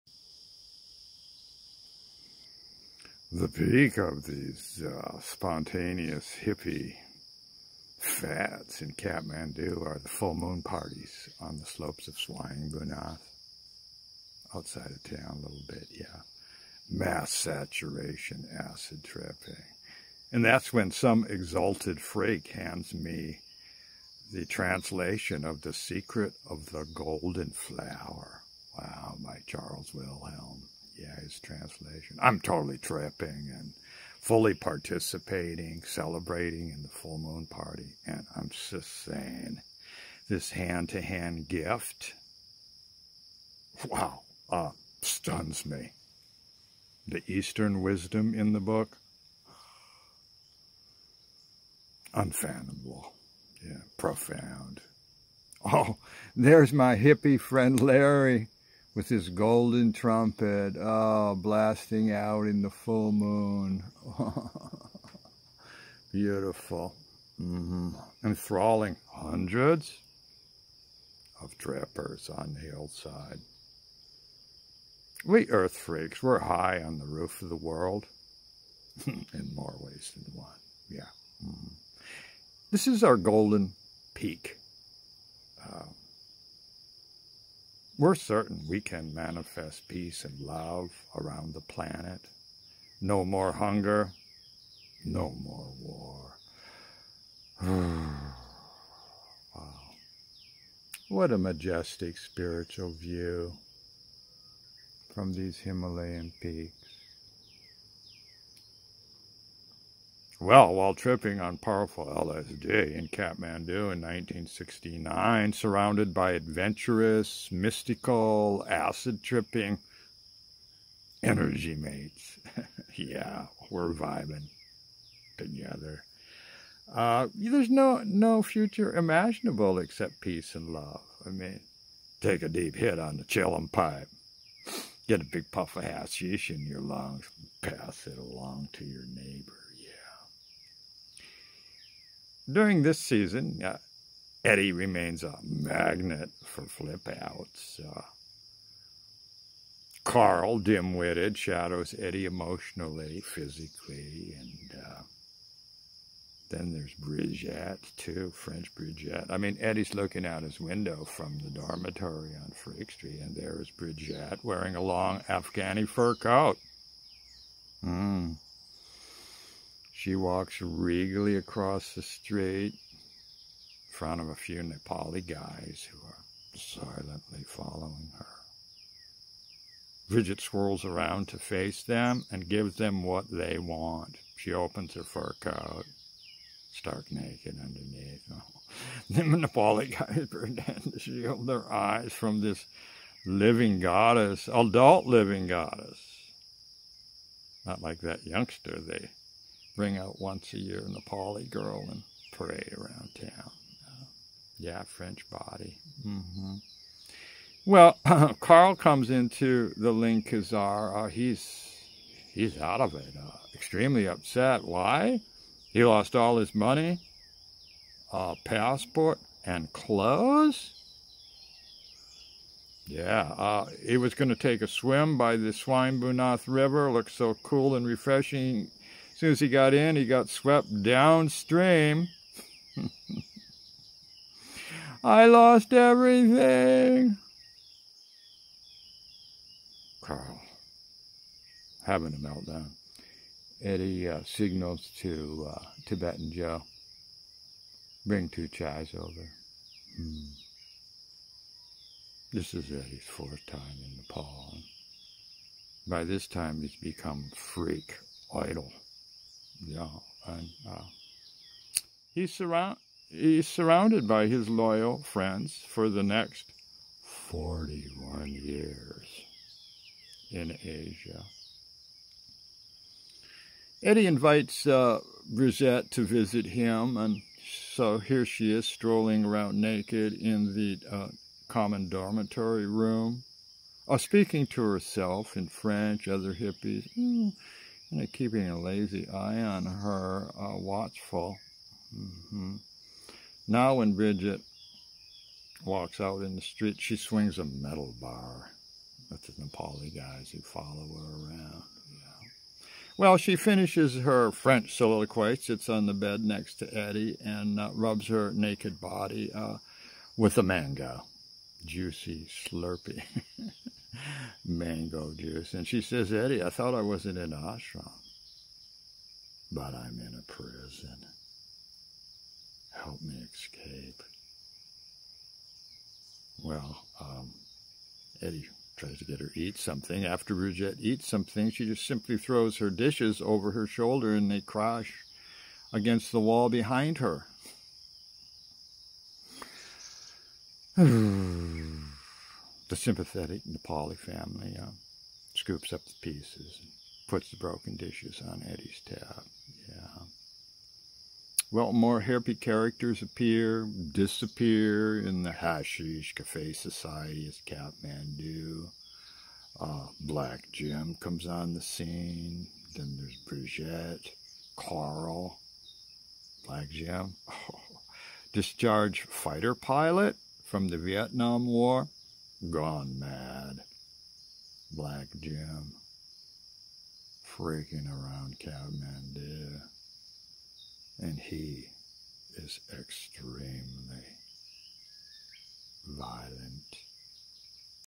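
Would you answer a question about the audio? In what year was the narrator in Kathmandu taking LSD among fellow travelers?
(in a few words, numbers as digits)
1969.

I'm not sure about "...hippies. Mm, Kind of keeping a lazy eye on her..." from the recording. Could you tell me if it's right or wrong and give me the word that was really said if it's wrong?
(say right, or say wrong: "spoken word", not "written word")
right.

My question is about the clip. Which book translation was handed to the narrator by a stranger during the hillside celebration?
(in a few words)
The Secret of the Golden Flower.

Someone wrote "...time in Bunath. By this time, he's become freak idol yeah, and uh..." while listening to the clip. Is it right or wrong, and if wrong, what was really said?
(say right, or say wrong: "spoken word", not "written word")
wrong: "Nepal", not "Bunath".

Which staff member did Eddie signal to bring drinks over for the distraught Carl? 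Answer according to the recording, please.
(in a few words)
Tibetan Joe.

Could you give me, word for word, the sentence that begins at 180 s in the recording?
Bridget swirls around to face them and gives them what they want.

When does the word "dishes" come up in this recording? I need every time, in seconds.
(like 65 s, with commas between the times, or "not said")
332 s, 347 s.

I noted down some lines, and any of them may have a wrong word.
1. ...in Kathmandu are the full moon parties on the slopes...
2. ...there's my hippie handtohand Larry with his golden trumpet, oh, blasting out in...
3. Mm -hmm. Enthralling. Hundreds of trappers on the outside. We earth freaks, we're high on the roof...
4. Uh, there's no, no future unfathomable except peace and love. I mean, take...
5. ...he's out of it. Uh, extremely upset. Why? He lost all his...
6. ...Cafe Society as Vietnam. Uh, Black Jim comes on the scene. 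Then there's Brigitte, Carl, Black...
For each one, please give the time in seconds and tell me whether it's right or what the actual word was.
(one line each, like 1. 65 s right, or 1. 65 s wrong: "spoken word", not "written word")
1. 8 s right
2. 56 s wrong: "friend", not "handtohand"
3. 67 s wrong: "hillside", not "outside"
4. 126 s wrong: "imaginable", not "unfathomable"
5. 212 s right
6. 356 s wrong: "Kathmandu", not "Vietnam".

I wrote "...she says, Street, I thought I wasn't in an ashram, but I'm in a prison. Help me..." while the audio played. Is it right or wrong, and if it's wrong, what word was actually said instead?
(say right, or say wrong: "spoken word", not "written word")
wrong: "Eddie", not "Street".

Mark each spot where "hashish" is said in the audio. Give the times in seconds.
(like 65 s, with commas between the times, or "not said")
135 s, 355 s.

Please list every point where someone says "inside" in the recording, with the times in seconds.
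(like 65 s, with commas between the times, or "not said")
not said.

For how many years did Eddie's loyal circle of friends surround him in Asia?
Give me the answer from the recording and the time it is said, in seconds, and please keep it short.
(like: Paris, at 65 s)
41, at 267 s.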